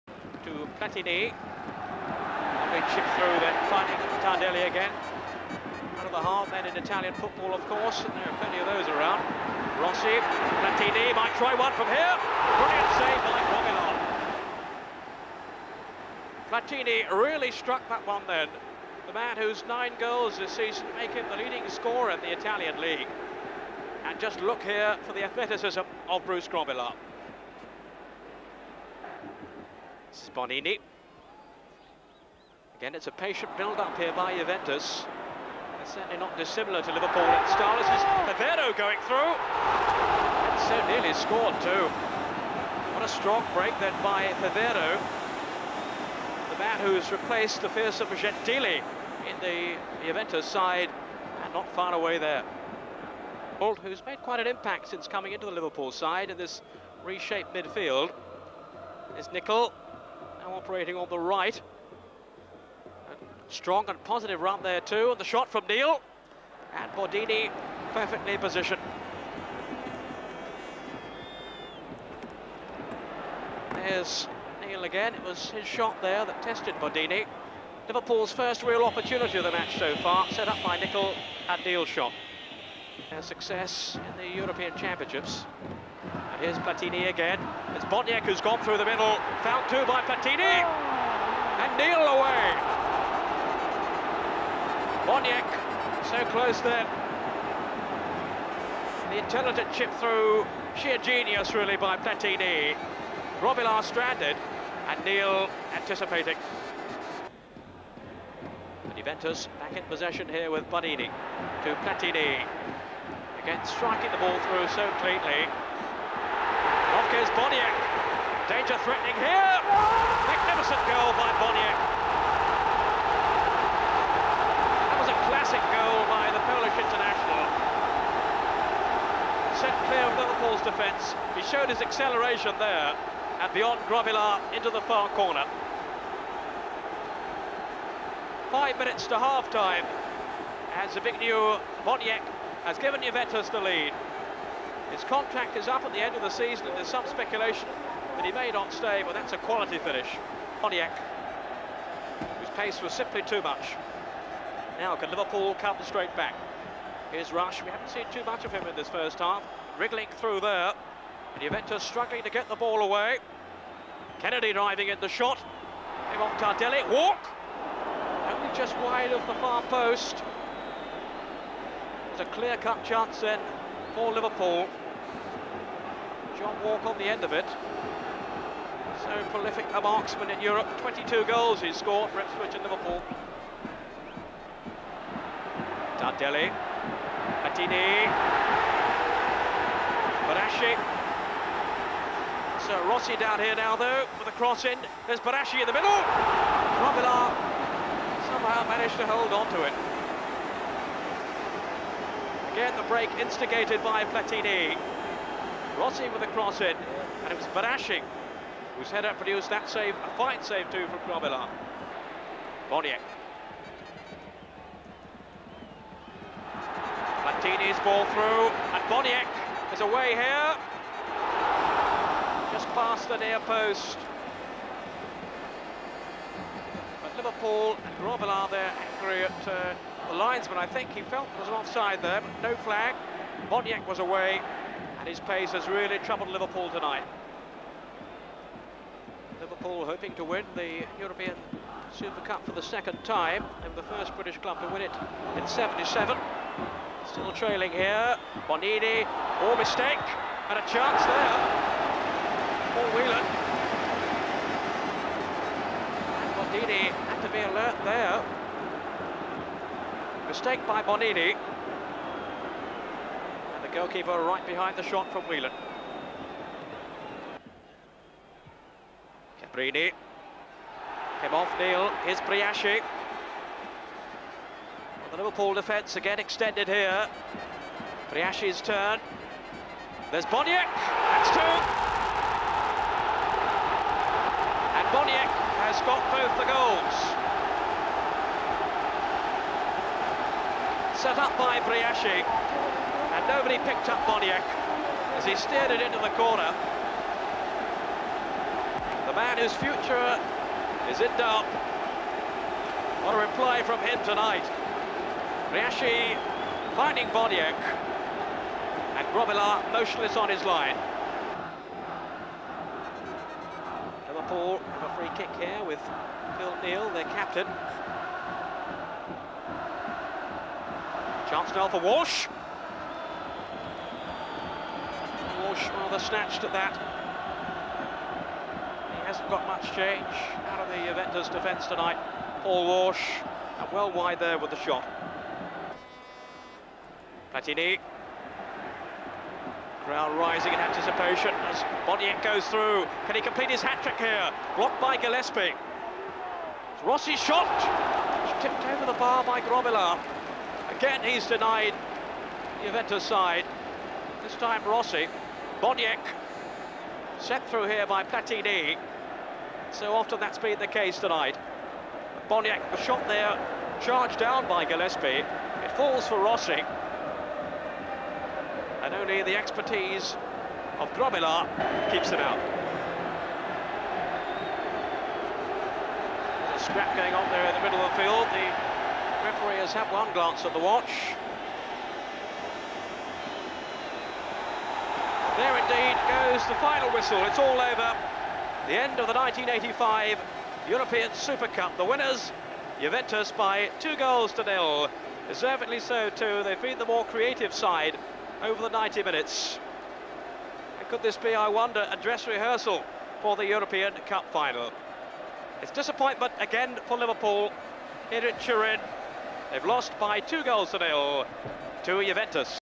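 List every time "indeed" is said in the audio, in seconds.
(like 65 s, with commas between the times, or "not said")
385 s.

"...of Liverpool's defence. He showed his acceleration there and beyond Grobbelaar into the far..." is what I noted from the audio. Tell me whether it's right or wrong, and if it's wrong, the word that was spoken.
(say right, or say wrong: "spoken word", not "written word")
right.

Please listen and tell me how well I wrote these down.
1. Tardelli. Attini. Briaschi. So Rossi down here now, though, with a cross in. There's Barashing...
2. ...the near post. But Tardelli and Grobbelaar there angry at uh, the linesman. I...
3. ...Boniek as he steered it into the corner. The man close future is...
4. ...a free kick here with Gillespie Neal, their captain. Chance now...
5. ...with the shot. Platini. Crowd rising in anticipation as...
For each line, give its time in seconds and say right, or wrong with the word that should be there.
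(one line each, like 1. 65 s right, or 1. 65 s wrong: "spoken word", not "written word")
1. 185 s wrong: "Briaschi", not "Barashing"
2. 223 s wrong: "Liverpool", not "Tardelli"
3. 294 s wrong: "whose", not "close"
4. 314 s wrong: "Phil", not "Gillespie"
5. 334 s right.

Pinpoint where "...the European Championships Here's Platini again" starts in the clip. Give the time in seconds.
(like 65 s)
84 s.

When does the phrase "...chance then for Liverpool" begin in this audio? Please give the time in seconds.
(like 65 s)
172 s.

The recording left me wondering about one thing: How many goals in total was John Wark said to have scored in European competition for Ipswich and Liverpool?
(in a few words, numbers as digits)
22.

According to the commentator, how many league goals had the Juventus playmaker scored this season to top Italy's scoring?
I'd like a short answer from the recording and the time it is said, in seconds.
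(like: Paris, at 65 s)
9, at 19 s.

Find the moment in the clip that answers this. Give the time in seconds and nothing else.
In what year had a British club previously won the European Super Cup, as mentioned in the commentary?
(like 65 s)
245 s.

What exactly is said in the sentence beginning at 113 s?
Again, striking the ball through so cleanly.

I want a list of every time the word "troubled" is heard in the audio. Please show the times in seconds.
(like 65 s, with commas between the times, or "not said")
235 s.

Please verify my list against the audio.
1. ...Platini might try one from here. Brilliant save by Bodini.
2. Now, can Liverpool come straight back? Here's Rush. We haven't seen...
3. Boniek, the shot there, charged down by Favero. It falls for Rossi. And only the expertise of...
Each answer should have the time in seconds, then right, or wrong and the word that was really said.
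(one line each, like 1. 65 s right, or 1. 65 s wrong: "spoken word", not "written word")
1. 10 s wrong: "Romilon", not "Bodini"
2. 154 s right
3. 362 s wrong: "Gillespie", not "Favero".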